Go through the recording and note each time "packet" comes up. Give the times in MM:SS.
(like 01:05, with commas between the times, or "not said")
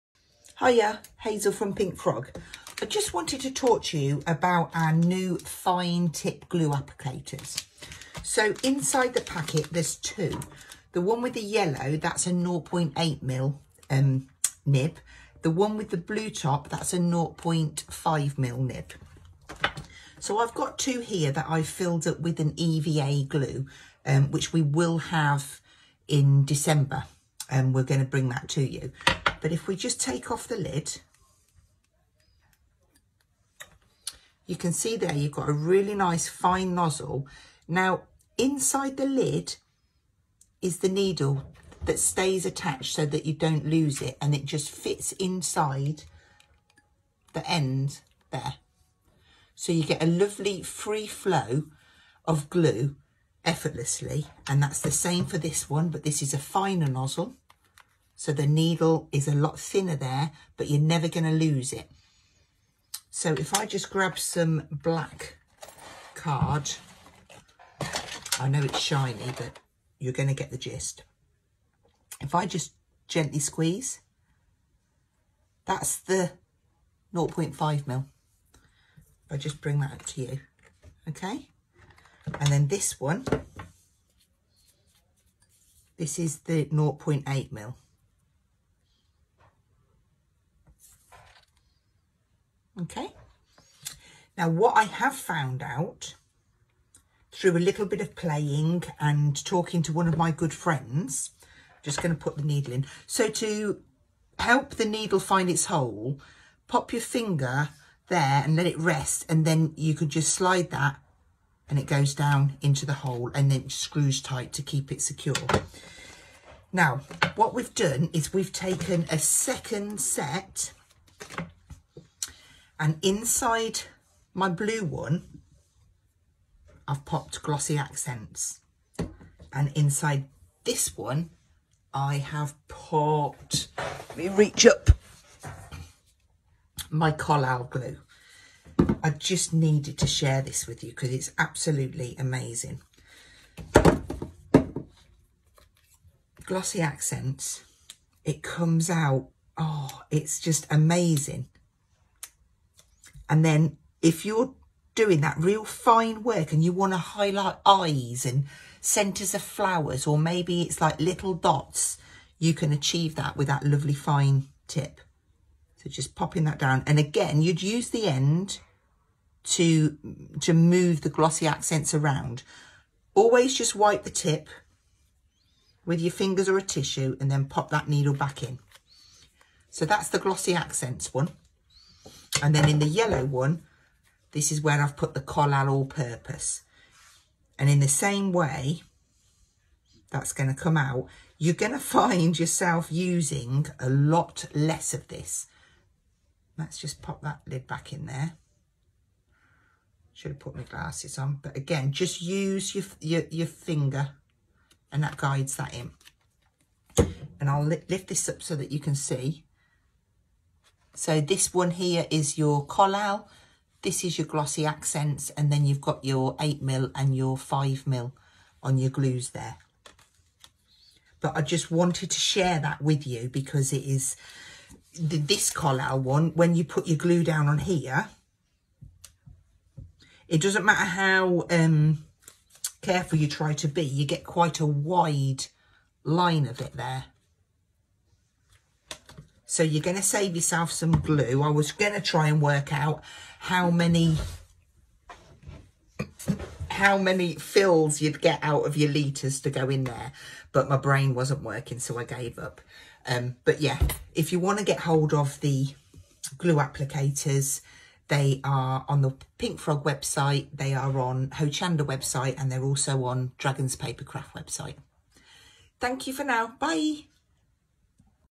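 00:09.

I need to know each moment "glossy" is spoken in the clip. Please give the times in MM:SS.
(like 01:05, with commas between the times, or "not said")
02:07, 02:26, 02:51, 03:00, 03:34.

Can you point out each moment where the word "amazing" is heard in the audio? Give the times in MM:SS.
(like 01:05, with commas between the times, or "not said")
02:22, 02:30.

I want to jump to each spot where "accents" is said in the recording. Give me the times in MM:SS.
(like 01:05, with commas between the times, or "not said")
02:07, 02:26, 02:51, 03:00, 03:34.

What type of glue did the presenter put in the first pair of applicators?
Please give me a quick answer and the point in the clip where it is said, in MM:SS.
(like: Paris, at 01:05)
EVA glue, at 00:22.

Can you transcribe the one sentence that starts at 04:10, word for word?
But my brain wasn't working, so I gave up.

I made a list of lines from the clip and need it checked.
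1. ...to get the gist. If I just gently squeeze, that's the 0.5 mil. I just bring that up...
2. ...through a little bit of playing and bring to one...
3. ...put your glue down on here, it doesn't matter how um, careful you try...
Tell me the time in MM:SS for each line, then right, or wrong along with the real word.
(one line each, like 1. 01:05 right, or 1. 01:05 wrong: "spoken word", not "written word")
1. 01:10 right
2. 01:37 wrong: "talking", not "bring"
3. 03:46 right.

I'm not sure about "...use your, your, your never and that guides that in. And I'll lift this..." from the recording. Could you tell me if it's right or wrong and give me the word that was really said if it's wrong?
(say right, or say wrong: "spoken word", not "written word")
wrong: "finger", not "never".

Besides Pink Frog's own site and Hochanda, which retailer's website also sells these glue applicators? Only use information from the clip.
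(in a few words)
Dragon's Papercraft.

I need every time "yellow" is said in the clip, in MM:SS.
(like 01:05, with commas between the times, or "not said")
00:11, 03:02.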